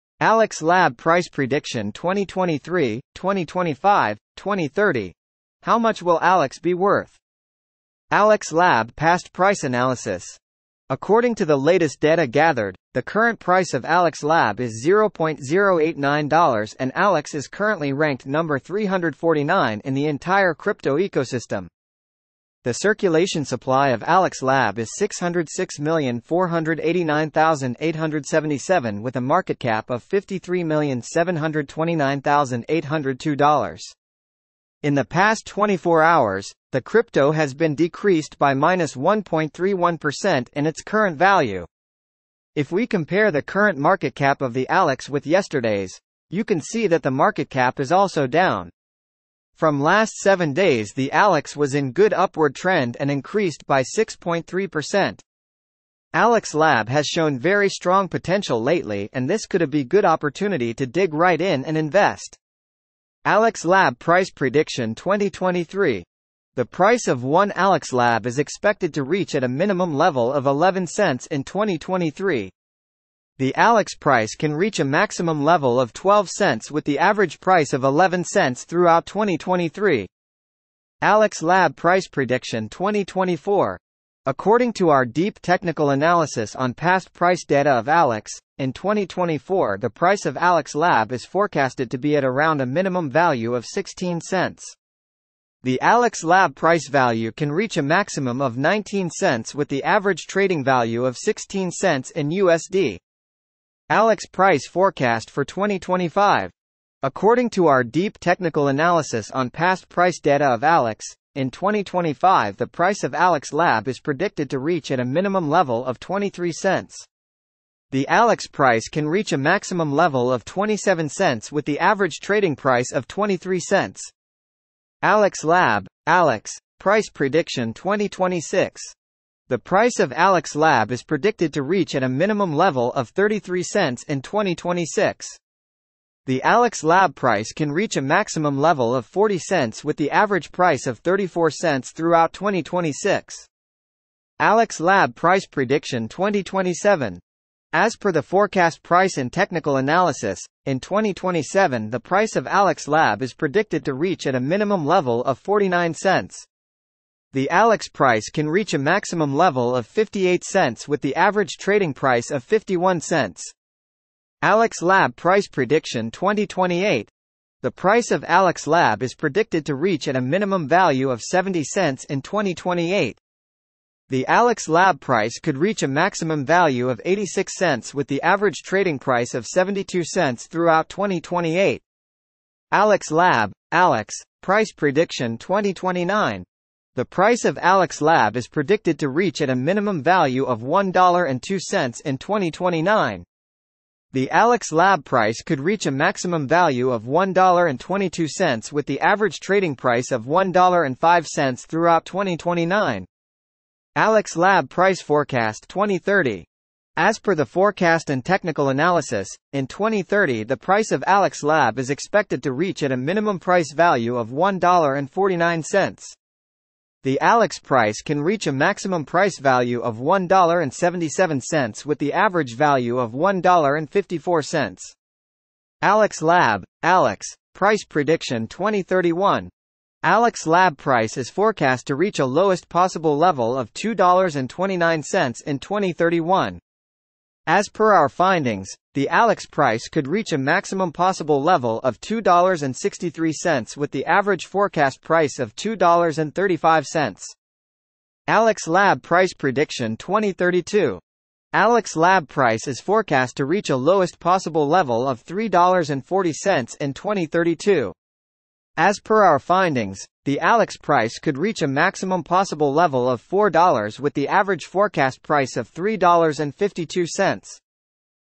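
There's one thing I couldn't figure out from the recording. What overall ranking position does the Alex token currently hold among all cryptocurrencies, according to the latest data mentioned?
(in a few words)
349.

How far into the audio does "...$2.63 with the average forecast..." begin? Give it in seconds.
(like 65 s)
241 s.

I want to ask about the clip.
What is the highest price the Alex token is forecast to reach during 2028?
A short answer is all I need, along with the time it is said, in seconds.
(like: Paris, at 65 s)
86 cents, at 177 s.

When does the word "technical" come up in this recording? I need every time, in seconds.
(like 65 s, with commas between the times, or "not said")
85 s, 108 s, 149 s, 208 s.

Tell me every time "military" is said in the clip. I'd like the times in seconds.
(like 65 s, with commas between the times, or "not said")
not said.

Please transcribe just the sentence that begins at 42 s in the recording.
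If we compare the current market cap of the Alex with yesterday's, you can see that the market cap is also down.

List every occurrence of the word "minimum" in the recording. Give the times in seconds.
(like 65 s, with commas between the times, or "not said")
69 s, 92 s, 115 s, 132 s, 154 s, 170 s, 189 s, 212 s.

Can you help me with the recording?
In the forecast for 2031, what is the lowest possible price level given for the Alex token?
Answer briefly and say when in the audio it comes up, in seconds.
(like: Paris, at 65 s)
$2.29, at 233 s.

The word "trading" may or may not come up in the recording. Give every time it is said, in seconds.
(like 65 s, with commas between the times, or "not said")
100 s, 122 s, 161 s, 178 s, 199 s.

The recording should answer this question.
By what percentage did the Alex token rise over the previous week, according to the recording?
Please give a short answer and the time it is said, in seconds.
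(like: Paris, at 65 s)
6.3%, at 53 s.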